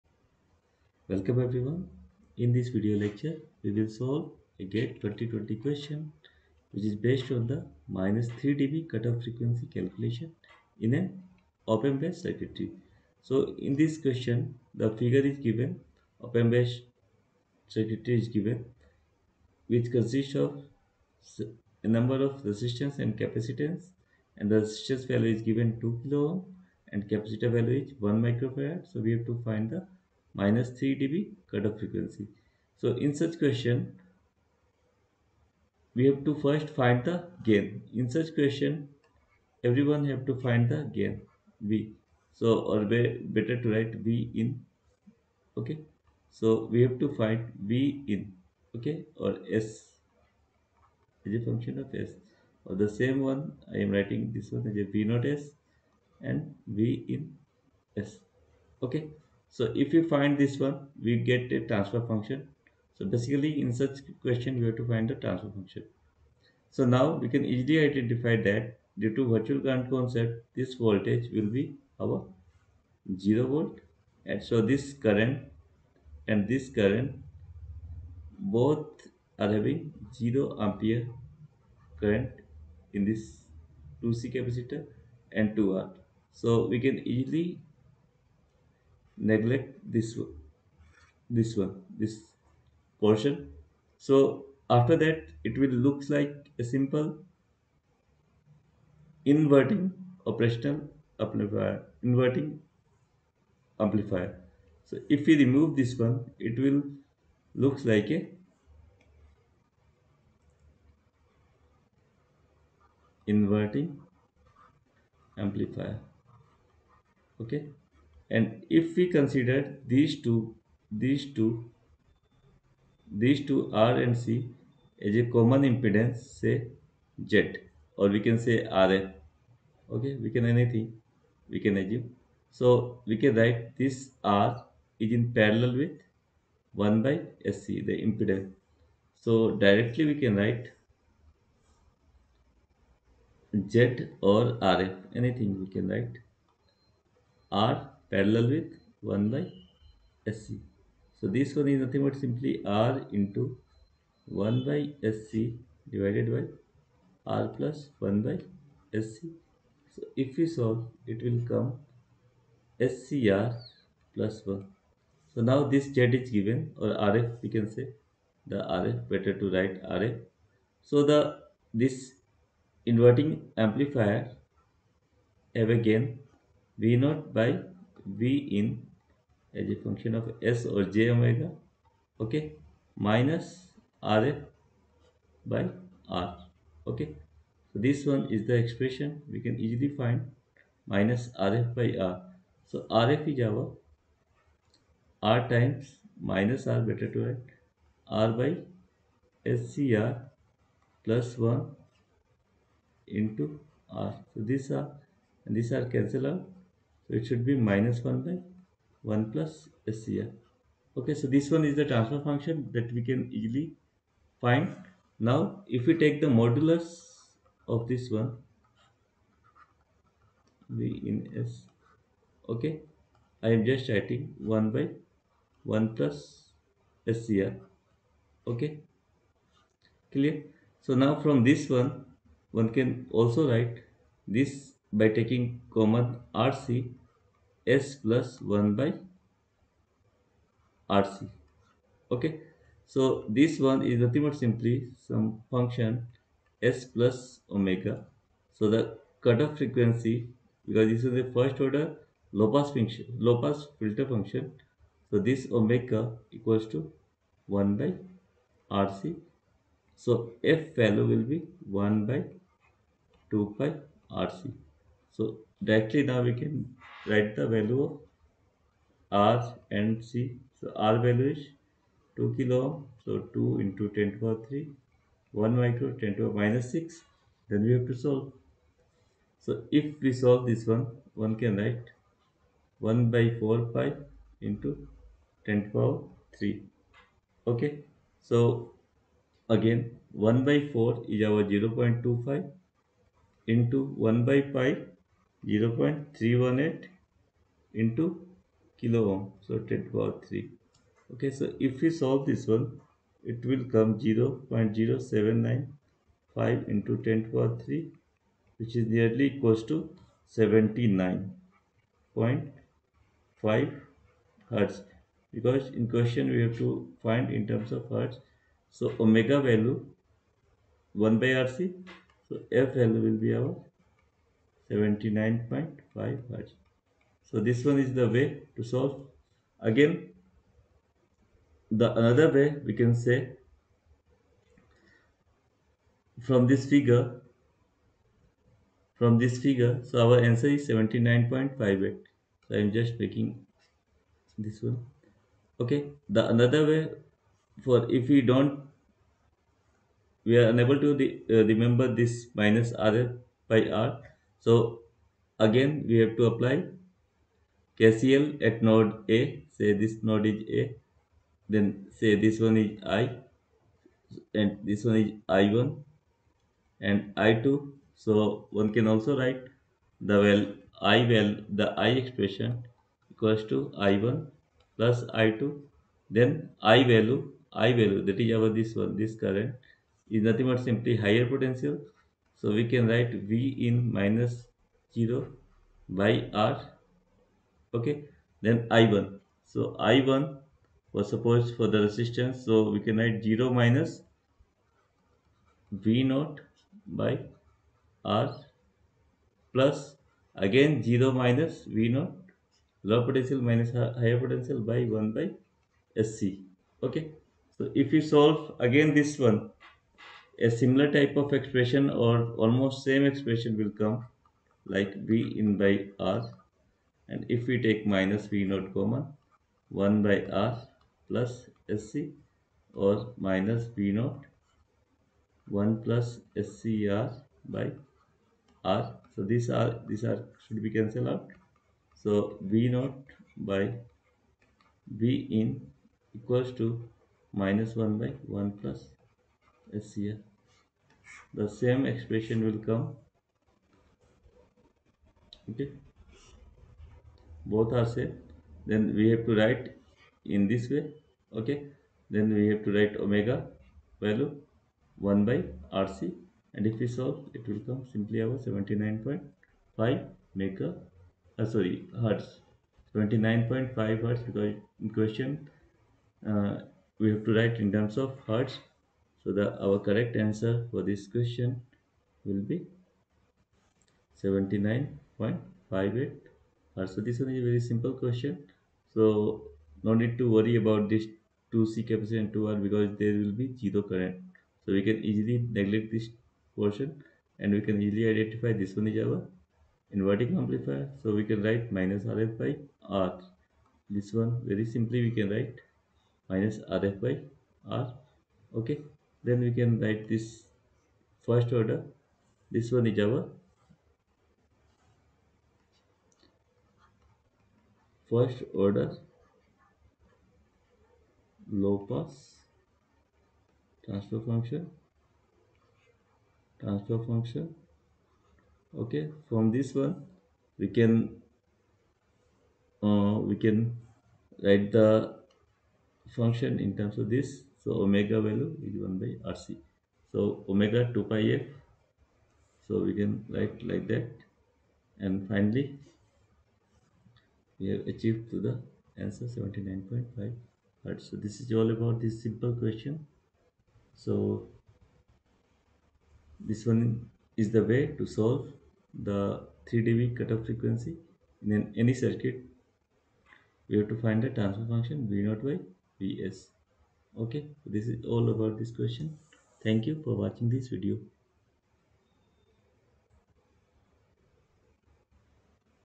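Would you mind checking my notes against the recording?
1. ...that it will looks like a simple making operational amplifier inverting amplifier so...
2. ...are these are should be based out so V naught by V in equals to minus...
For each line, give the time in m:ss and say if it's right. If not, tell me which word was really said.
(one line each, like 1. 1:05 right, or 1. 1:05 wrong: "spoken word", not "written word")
1. 1:35 wrong: "inverting", not "making"
2. 7:09 wrong: "cancelled", not "based".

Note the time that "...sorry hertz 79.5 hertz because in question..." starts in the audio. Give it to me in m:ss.
7:41.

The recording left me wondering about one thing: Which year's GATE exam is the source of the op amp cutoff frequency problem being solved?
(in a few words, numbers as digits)
2020.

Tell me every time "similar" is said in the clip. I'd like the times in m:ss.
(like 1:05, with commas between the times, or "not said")
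6:50.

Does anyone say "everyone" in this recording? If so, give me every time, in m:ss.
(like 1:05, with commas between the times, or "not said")
0:01, 0:39.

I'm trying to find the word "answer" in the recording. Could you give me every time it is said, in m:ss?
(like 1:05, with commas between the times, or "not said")
5:40, 7:50, 8:58.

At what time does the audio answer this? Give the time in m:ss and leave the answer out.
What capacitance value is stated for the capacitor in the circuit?
0:28.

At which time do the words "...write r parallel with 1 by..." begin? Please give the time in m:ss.
2:25.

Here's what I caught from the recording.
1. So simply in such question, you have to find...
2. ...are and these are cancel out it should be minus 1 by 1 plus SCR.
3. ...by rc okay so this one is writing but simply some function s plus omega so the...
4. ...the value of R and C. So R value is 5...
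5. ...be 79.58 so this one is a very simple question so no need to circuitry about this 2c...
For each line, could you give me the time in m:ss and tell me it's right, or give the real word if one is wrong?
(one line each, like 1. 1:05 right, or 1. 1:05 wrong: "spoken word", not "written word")
1. 1:02 wrong: "basically", not "simply"
2. 3:24 right
3. 3:58 wrong: "nothing", not "writing"
4. 4:27 wrong: "2", not "5"
5. 7:52 wrong: "worry", not "circuitry".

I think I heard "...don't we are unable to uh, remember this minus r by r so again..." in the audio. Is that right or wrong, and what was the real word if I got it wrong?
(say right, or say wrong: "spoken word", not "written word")
right.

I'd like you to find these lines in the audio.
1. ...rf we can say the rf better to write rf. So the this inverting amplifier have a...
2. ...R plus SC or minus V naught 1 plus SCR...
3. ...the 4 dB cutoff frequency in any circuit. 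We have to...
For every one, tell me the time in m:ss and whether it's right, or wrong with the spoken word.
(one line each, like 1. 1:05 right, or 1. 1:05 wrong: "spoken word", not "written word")
1. 2:47 right
2. 7:00 right
3. 9:09 wrong: "3", not "4".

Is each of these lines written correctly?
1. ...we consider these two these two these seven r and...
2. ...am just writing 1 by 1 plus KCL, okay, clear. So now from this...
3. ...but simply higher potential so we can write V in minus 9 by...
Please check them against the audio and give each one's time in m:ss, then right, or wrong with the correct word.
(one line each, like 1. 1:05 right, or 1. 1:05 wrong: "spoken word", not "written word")
1. 1:58 wrong: "two", not "seven"
2. 3:43 wrong: "SCR", not "KCL"
3. 6:20 wrong: "0", not "9".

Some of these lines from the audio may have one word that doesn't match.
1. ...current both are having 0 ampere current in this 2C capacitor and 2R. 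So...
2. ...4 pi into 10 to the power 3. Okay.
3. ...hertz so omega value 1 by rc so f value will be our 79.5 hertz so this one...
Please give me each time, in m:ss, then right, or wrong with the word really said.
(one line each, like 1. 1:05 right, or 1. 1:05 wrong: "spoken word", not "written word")
1. 1:16 right
2. 4:43 right
3. 5:17 right.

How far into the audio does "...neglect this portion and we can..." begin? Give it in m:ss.
8:05.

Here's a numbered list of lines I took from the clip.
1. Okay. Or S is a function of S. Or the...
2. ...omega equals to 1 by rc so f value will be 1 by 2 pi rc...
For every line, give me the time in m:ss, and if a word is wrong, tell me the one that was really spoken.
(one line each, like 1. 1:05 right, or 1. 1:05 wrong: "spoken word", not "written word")
1. 0:48 right
2. 4:15 right.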